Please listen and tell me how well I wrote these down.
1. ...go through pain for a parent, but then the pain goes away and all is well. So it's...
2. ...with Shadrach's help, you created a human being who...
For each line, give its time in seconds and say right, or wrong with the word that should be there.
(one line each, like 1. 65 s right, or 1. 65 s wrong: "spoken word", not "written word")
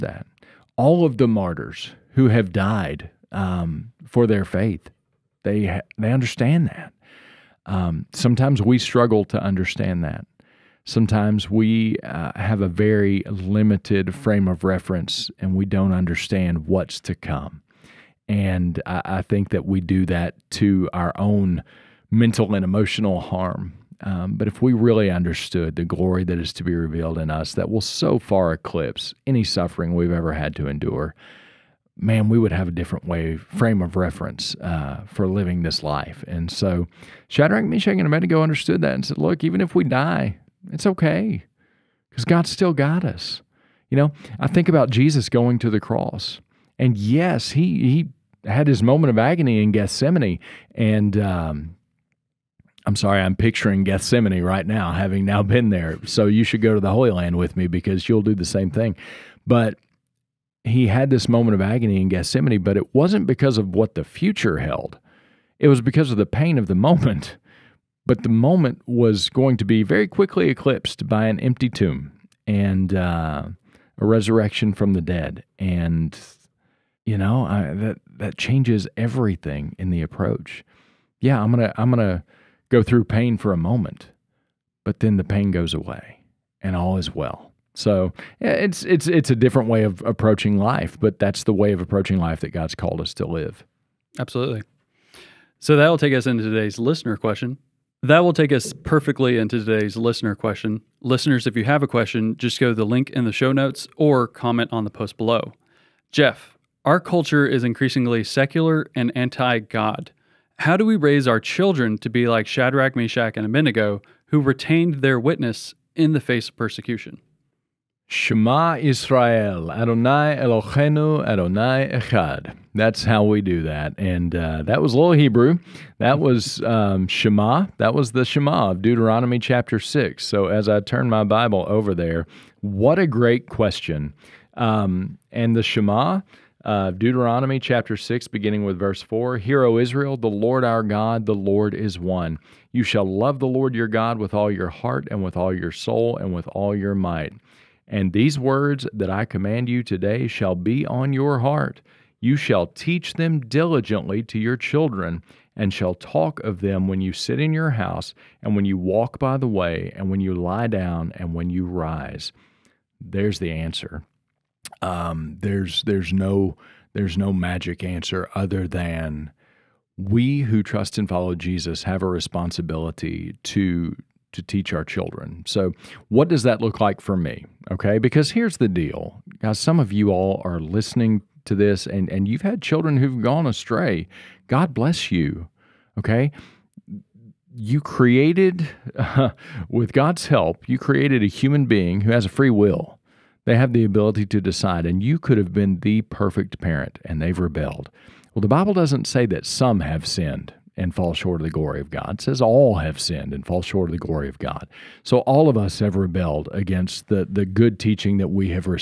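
1. 82 s wrong: "moment", not "parent"
2. 189 s wrong: "God", not "Shadrach".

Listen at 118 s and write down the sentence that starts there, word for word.
Shema Israel, Adonai Eloheinu, Adonai Echad.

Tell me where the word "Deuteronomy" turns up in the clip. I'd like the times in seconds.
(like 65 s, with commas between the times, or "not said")
128 s, 136 s.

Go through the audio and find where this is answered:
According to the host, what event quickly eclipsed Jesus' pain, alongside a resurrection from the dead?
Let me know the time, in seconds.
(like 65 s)
71 s.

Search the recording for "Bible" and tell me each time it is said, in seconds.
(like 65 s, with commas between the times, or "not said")
131 s, 198 s.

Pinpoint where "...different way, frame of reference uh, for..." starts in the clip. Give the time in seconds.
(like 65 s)
32 s.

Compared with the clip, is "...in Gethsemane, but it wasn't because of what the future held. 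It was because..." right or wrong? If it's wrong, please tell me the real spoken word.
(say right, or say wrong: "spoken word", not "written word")
right.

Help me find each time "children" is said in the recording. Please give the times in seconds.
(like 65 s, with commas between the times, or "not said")
111 s, 154 s, 174 s, 182 s.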